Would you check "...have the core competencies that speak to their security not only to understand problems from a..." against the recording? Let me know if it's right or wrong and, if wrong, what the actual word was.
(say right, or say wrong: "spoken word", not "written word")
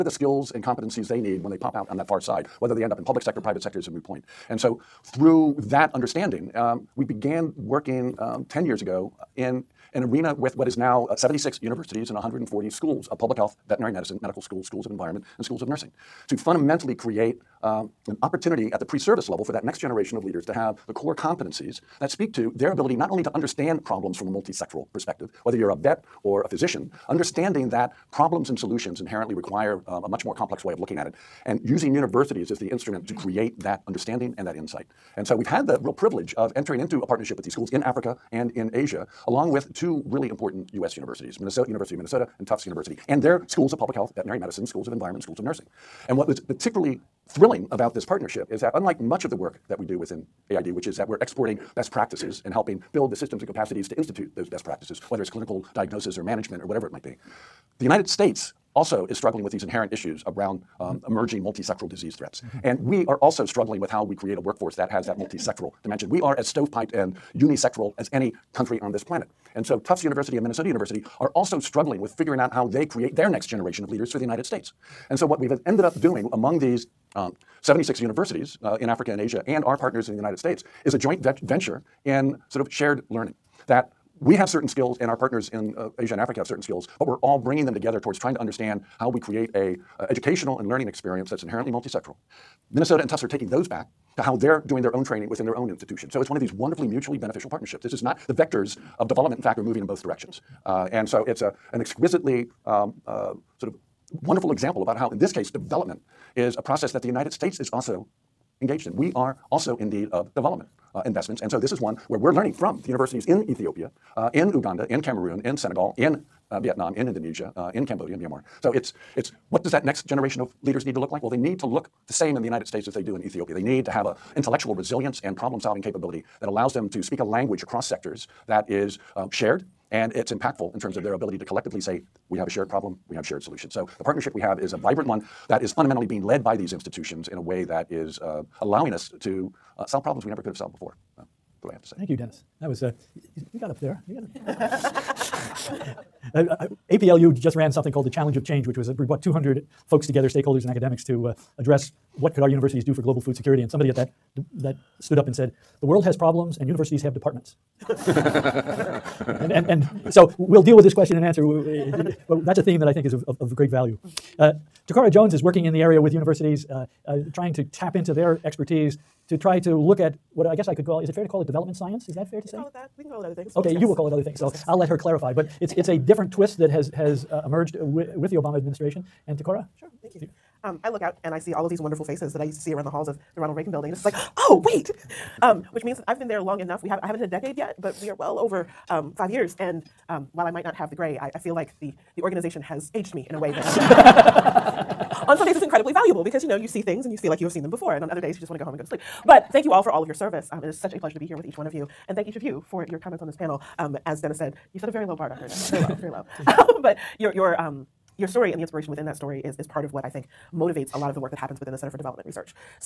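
wrong: "ability", not "security".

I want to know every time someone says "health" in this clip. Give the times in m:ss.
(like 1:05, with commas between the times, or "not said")
0:13, 0:43.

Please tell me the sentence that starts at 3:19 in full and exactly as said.
But thank you all for all of your service.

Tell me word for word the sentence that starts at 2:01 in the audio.
Well, they need to look the same in the United States as they do in Ethiopia.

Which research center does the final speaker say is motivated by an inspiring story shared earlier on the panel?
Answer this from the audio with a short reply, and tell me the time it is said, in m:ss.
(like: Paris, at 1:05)
Center for Development Research, at 3:31.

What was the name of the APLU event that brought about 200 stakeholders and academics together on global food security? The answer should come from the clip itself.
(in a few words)
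Challenge of Change.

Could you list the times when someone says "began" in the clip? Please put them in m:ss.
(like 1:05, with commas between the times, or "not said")
0:07.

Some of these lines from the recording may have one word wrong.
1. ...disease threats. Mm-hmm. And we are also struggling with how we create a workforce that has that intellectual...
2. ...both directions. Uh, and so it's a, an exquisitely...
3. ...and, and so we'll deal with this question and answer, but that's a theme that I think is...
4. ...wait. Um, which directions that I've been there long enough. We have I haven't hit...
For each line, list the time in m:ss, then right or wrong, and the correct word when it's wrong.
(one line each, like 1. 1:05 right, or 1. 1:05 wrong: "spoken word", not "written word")
1. 1:01 wrong: "multisectoral", not "intellectual"
2. 1:39 right
3. 2:39 right
4. 3:04 wrong: "means", not "directions".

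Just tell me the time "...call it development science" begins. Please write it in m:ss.
2:51.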